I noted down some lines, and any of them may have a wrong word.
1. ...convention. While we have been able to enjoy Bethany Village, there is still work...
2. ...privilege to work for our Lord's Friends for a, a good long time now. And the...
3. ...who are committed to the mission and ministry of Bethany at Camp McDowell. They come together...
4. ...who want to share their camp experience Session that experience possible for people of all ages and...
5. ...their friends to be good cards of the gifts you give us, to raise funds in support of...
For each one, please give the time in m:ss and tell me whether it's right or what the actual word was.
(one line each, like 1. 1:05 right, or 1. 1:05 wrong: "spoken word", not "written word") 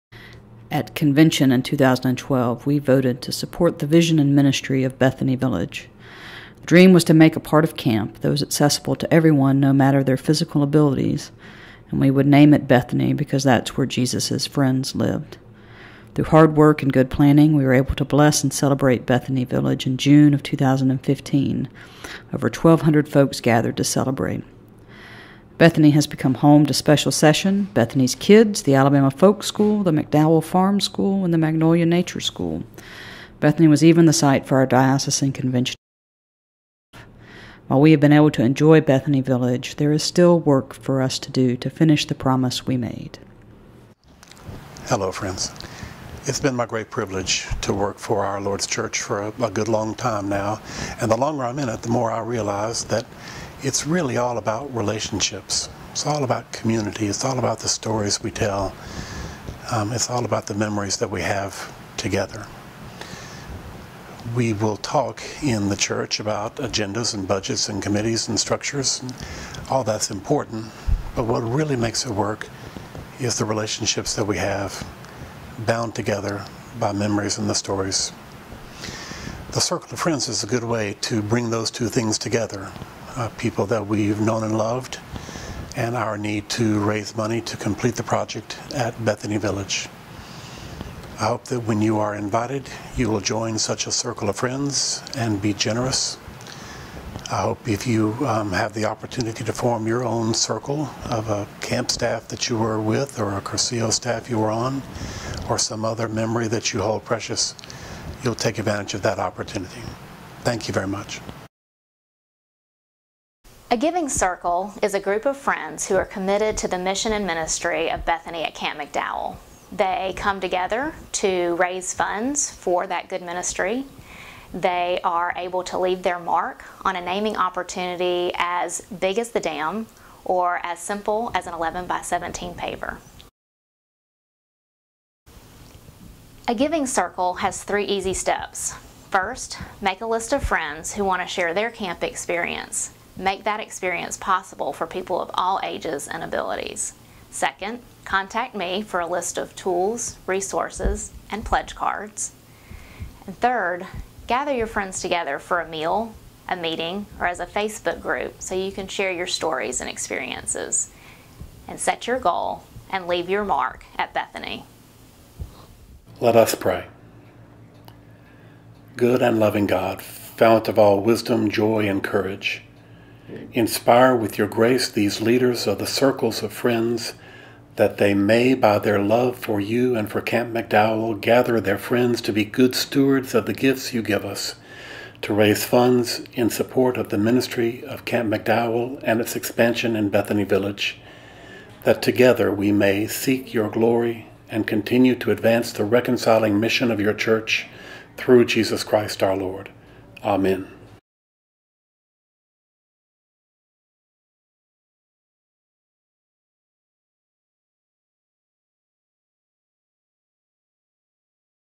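1. 0:35 right
2. 0:46 wrong: "Church", not "Friends"
3. 1:55 right
4. 2:20 wrong: "Make", not "Session"
5. 3:01 wrong: "stewards", not "cards".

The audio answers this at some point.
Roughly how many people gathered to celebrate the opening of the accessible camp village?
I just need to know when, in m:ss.
0:22.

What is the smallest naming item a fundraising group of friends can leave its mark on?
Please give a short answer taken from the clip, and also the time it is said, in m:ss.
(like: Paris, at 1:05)
11 by 17 paver, at 2:11.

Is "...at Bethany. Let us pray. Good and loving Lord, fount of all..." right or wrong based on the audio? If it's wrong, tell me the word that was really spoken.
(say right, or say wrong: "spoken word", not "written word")
wrong: "God", not "Lord".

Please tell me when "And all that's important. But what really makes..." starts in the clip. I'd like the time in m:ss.
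1:09.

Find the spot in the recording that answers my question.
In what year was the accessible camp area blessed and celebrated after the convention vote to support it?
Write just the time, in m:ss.
0:19.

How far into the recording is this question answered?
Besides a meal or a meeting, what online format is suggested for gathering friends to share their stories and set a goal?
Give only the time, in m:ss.
2:37.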